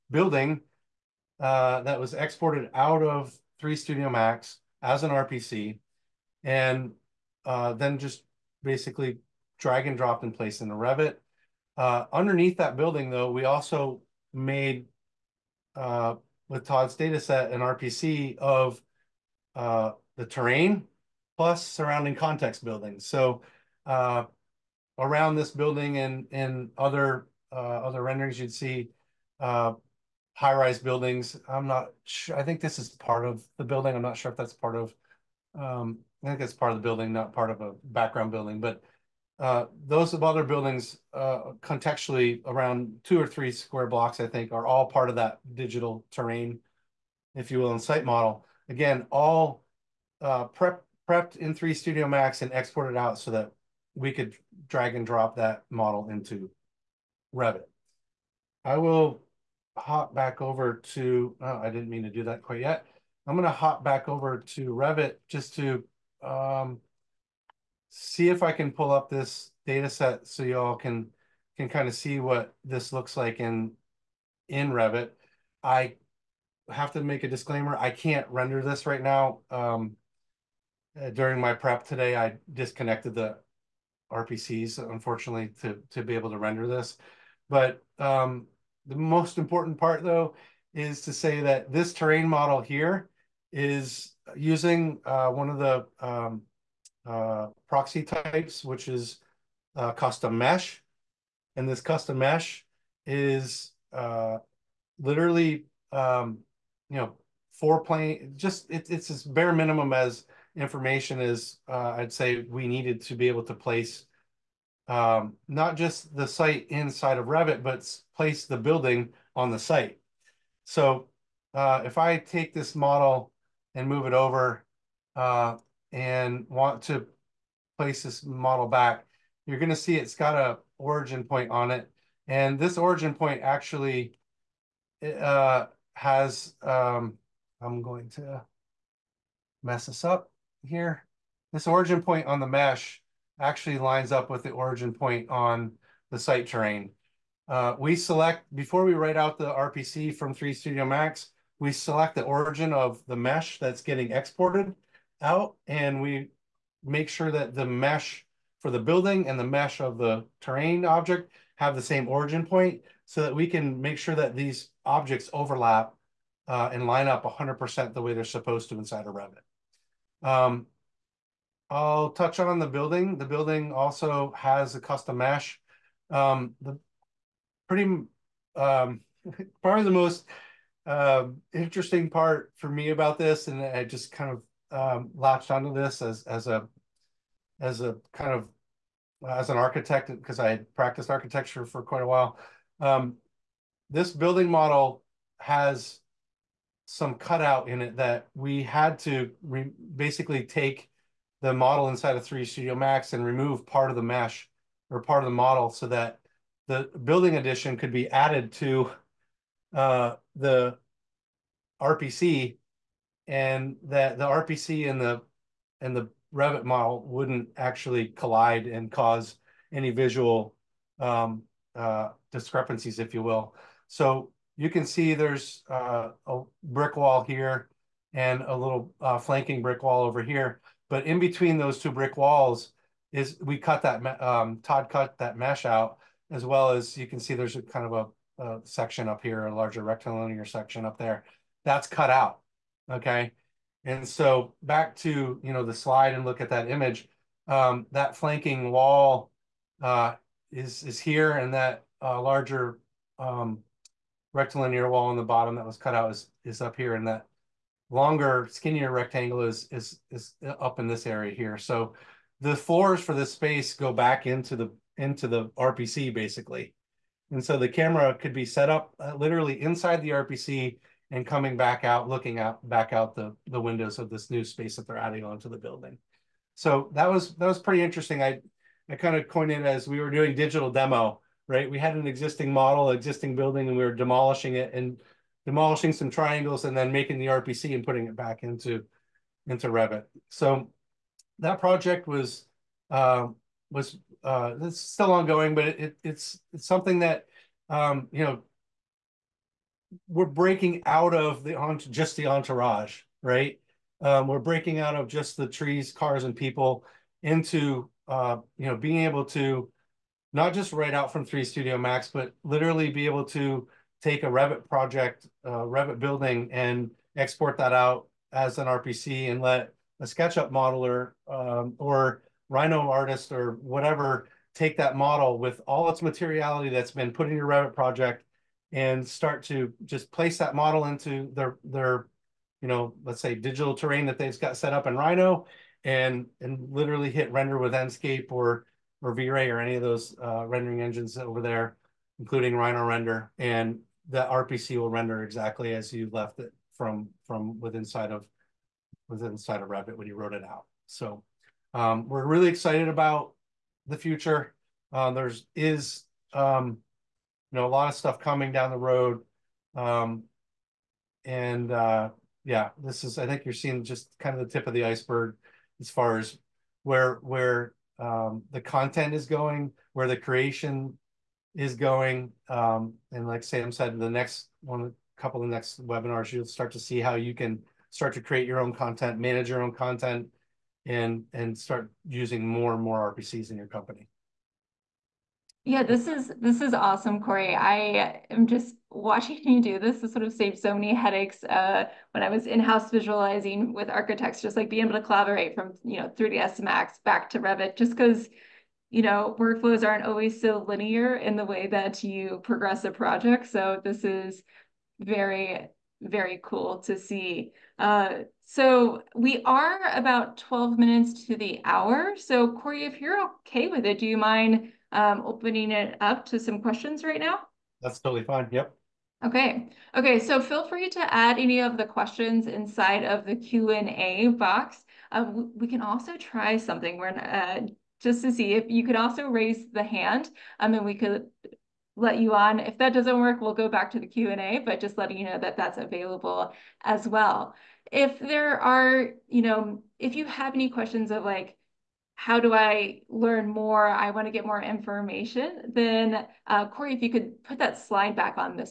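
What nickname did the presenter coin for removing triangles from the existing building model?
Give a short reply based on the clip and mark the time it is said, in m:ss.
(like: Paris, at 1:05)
digital demo, at 4:40.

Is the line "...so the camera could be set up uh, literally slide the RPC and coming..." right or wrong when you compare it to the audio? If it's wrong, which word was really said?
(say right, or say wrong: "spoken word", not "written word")
wrong: "inside", not "slide".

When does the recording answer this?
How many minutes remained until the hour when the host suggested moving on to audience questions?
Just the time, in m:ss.
6:50.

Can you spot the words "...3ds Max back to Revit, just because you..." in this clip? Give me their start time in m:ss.
6:36.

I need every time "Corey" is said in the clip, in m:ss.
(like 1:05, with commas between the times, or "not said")
6:27, 6:52, 7:26.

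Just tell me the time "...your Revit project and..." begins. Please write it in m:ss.
5:27.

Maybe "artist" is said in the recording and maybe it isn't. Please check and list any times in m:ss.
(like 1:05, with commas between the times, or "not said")
5:22.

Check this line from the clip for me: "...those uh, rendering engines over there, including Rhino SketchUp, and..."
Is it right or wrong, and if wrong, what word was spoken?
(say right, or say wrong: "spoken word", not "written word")
wrong: "Render", not "SketchUp".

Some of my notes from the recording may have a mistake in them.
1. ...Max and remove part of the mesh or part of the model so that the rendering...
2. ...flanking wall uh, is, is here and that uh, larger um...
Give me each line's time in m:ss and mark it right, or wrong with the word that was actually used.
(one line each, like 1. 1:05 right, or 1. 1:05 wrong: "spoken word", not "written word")
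1. 3:22 wrong: "building", not "rendering"
2. 4:08 right.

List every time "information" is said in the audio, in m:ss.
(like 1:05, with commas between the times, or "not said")
1:50, 7:24.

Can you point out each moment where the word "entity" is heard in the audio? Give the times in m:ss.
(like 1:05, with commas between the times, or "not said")
not said.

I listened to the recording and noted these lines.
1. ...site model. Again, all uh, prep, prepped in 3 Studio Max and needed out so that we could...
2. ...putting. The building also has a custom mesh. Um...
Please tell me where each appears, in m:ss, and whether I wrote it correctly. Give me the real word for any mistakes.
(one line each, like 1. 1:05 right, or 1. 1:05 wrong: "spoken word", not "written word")
1. 0:47 wrong: "exported", not "needed"
2. 2:52 wrong: "building", not "putting".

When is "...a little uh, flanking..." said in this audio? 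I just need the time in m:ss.
3:48.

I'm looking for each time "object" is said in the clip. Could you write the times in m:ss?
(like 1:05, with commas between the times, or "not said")
2:40, 2:44.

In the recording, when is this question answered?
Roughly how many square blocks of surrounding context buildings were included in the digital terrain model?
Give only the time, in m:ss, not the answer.
0:43.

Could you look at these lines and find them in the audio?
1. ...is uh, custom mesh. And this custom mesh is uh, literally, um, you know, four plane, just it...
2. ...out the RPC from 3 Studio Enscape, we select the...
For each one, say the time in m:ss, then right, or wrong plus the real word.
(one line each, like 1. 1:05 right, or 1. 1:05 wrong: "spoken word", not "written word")
1. 1:38 right
2. 2:29 wrong: "Max", not "Enscape".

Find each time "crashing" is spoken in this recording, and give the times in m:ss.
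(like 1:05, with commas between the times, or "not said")
not said.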